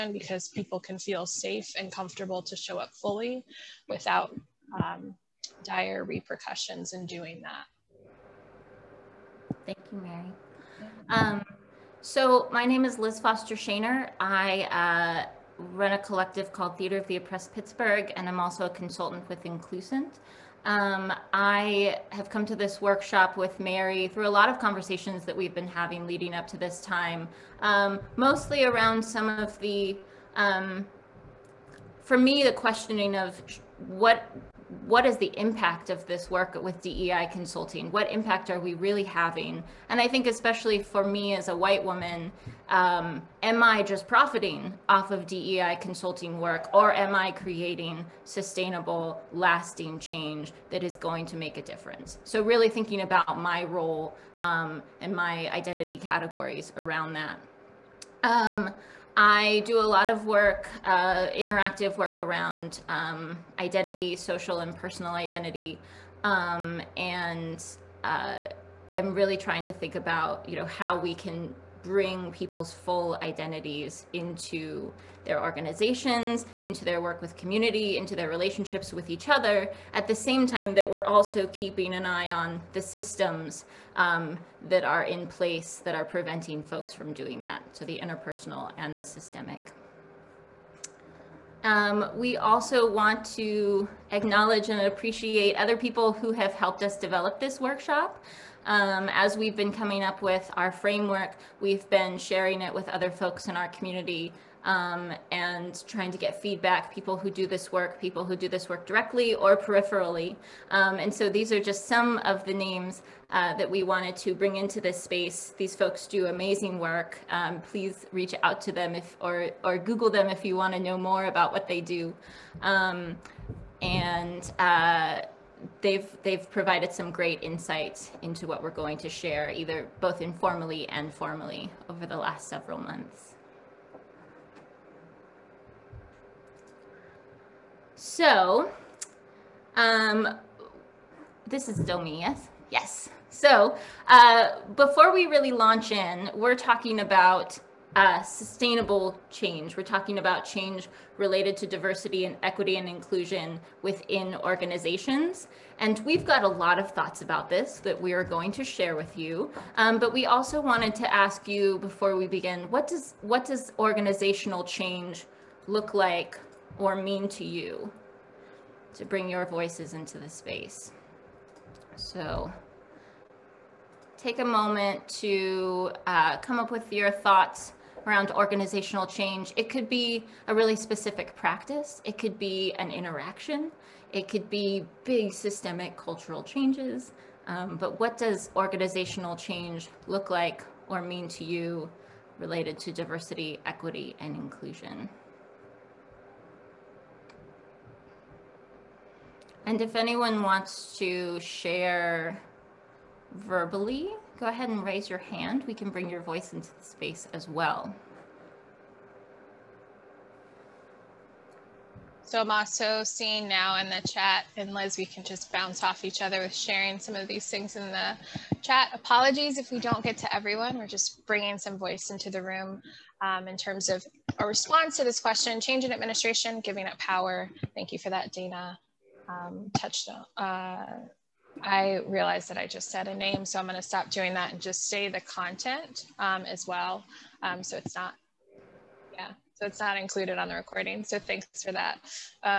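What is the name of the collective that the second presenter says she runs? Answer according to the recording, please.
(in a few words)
Theater of the Oppressed Pittsburgh.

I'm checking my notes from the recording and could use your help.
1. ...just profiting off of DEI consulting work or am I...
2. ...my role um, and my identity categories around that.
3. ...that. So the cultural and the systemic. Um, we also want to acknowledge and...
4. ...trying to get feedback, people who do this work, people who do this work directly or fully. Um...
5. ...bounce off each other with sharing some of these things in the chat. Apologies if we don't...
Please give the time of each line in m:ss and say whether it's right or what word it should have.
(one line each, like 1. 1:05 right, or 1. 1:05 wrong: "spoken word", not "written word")
1. 0:43 right
2. 0:53 right
3. 1:27 wrong: "interpersonal", not "cultural"
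4. 1:45 wrong: "peripherally", not "fully"
5. 3:35 right.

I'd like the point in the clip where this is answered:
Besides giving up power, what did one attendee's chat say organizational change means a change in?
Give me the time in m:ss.
3:45.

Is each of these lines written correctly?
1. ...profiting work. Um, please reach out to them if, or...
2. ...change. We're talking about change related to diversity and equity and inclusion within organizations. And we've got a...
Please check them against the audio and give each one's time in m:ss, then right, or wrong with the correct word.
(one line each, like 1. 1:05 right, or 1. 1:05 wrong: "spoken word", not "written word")
1. 1:56 wrong: "amazing", not "profiting"
2. 2:29 right.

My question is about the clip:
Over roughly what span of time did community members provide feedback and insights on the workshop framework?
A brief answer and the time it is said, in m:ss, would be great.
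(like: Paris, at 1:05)
the last several months, at 2:12.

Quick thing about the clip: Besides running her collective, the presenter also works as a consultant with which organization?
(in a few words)
Inclusent.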